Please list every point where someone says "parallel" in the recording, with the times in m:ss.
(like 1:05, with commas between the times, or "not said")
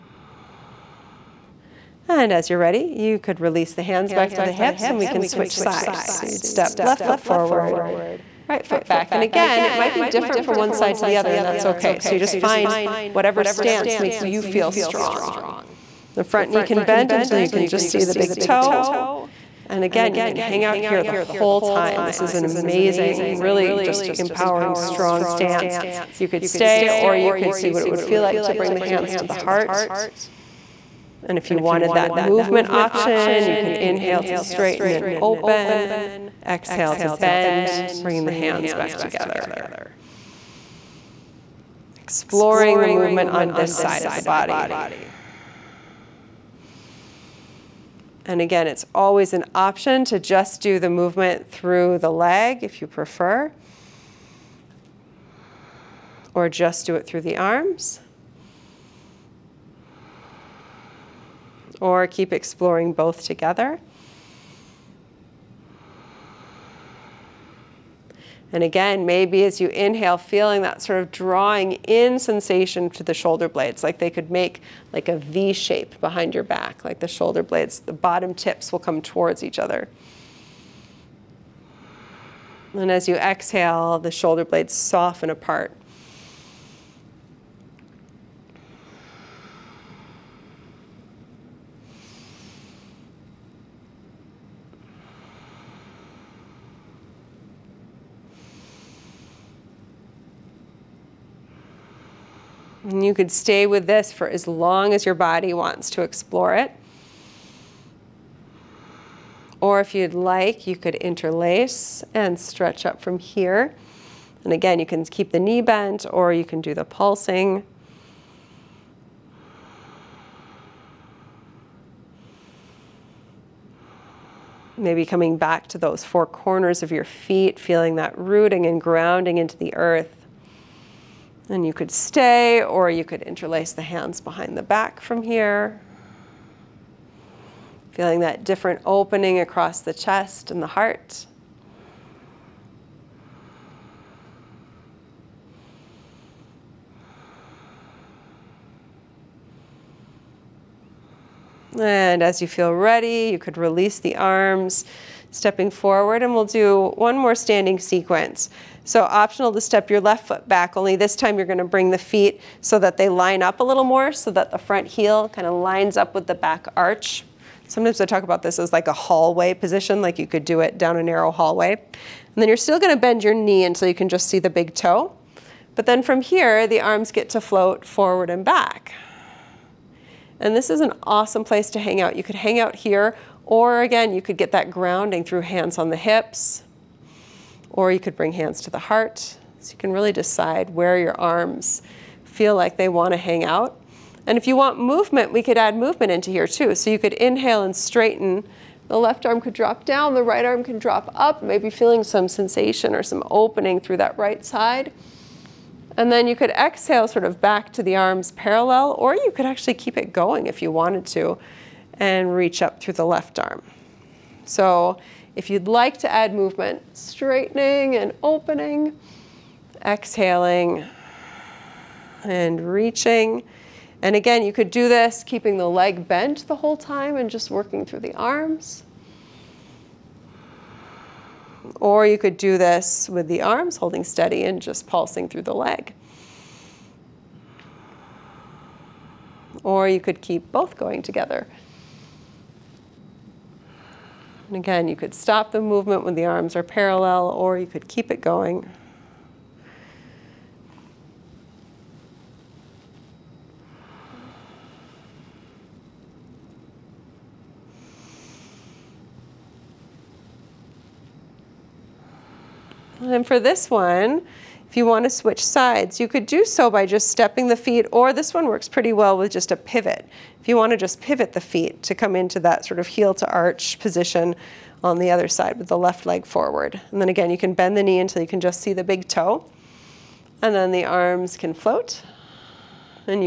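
3:28, 4:06.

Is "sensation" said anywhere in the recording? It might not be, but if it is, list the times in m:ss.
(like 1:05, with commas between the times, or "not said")
1:12, 3:22.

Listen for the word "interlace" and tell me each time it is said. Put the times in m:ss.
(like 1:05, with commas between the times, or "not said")
1:50, 2:13.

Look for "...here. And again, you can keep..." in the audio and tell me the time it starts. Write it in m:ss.
1:53.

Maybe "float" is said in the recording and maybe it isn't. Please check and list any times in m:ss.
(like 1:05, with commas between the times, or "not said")
2:57, 4:41.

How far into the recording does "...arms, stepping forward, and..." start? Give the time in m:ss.
2:34.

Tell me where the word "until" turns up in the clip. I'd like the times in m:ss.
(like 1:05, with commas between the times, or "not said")
0:17, 2:53, 4:37.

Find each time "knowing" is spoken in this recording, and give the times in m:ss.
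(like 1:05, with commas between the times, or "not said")
not said.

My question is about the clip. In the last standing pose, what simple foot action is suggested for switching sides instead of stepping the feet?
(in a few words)
a pivot.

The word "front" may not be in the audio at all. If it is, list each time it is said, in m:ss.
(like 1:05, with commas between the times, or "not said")
0:16, 2:44.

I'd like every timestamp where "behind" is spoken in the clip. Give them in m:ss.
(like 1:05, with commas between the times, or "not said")
1:16, 2:14.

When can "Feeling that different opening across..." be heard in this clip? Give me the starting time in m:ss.
2:17.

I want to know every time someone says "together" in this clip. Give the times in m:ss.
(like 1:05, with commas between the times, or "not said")
0:38, 1:03, 4:01.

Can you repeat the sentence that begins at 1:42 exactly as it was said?
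And you could stay with this for as long as your body wants to explore it.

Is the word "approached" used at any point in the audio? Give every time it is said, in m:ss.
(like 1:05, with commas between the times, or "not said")
not said.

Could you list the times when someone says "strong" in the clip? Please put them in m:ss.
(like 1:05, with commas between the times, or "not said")
0:14, 0:24.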